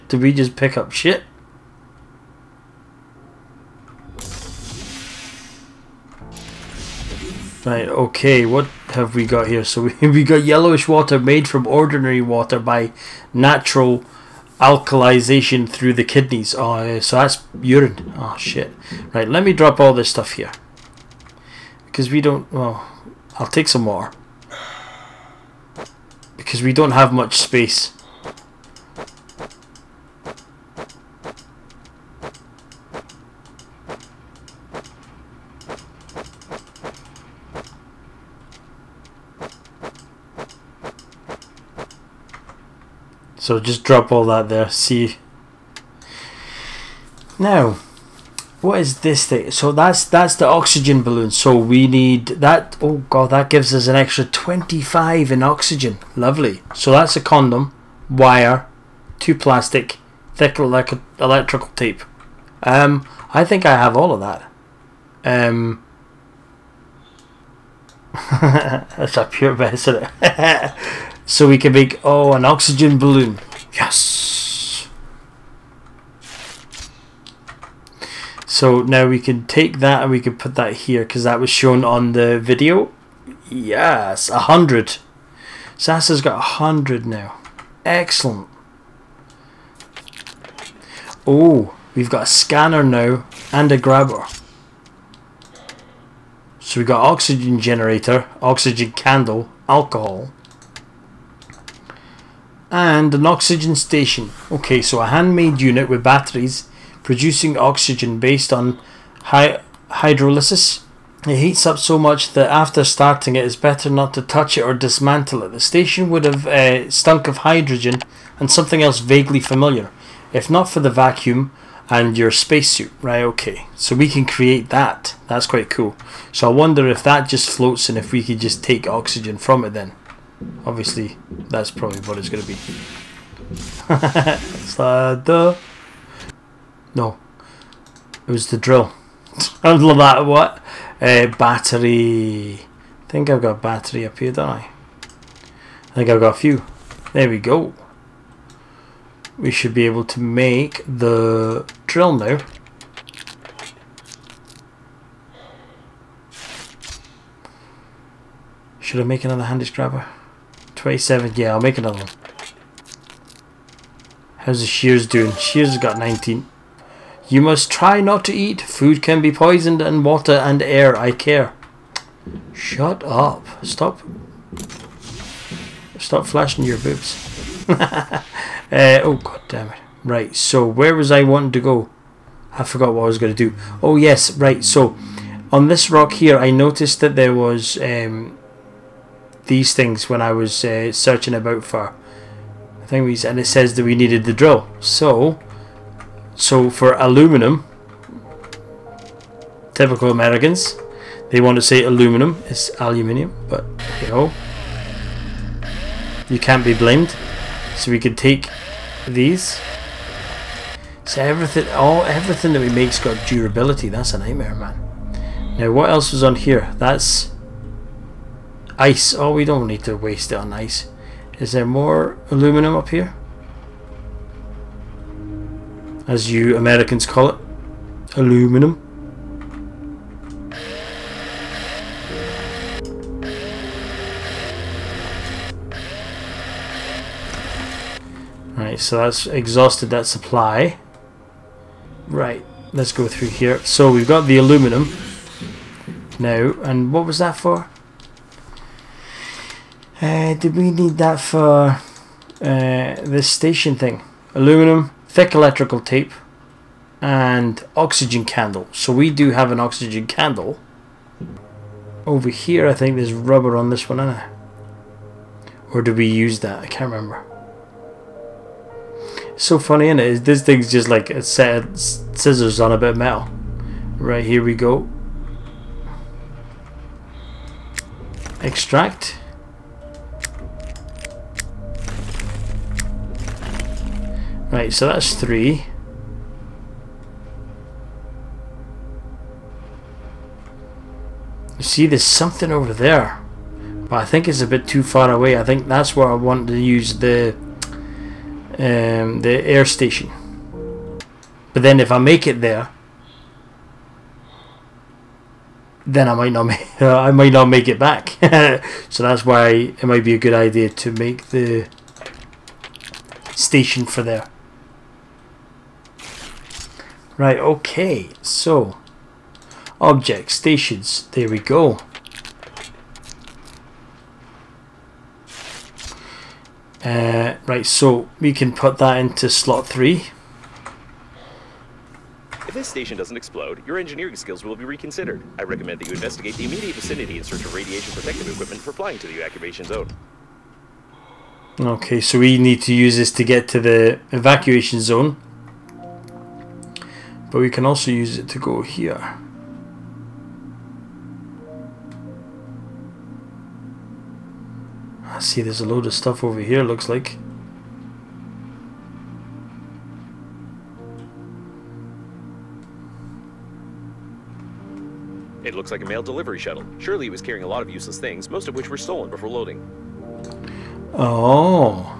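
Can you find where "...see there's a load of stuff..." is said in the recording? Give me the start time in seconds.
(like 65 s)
355 s.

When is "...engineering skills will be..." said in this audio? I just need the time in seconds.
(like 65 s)
333 s.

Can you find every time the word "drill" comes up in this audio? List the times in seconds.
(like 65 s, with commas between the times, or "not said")
138 s, 151 s, 194 s.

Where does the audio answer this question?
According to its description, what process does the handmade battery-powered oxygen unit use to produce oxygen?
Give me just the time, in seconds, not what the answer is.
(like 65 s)
109 s.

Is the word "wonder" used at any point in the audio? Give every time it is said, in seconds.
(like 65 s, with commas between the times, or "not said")
126 s.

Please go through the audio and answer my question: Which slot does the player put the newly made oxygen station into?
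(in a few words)
Slot 3.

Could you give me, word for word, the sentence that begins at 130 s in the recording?
Obviously, that's probably what it's going to be.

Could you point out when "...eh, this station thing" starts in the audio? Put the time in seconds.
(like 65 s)
252 s.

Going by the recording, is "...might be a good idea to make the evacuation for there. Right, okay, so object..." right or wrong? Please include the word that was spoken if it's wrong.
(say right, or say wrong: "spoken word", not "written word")
wrong: "station", not "evacuation".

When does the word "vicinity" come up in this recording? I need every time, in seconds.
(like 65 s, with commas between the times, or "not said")
336 s.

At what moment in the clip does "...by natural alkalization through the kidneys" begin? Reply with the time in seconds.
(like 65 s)
12 s.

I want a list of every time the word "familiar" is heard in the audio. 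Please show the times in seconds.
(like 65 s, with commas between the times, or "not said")
119 s.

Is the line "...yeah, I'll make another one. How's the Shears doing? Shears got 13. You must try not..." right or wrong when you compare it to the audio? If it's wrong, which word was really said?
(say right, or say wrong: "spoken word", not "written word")
wrong: "19", not "13".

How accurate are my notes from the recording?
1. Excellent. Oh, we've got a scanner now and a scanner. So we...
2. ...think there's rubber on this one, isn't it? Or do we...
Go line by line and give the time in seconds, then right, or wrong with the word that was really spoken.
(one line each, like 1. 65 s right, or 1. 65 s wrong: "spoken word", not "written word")
1. 87 s wrong: "grabber", not "scanner"
2. 262 s right.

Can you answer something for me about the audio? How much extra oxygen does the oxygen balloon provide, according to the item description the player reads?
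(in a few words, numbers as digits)
25.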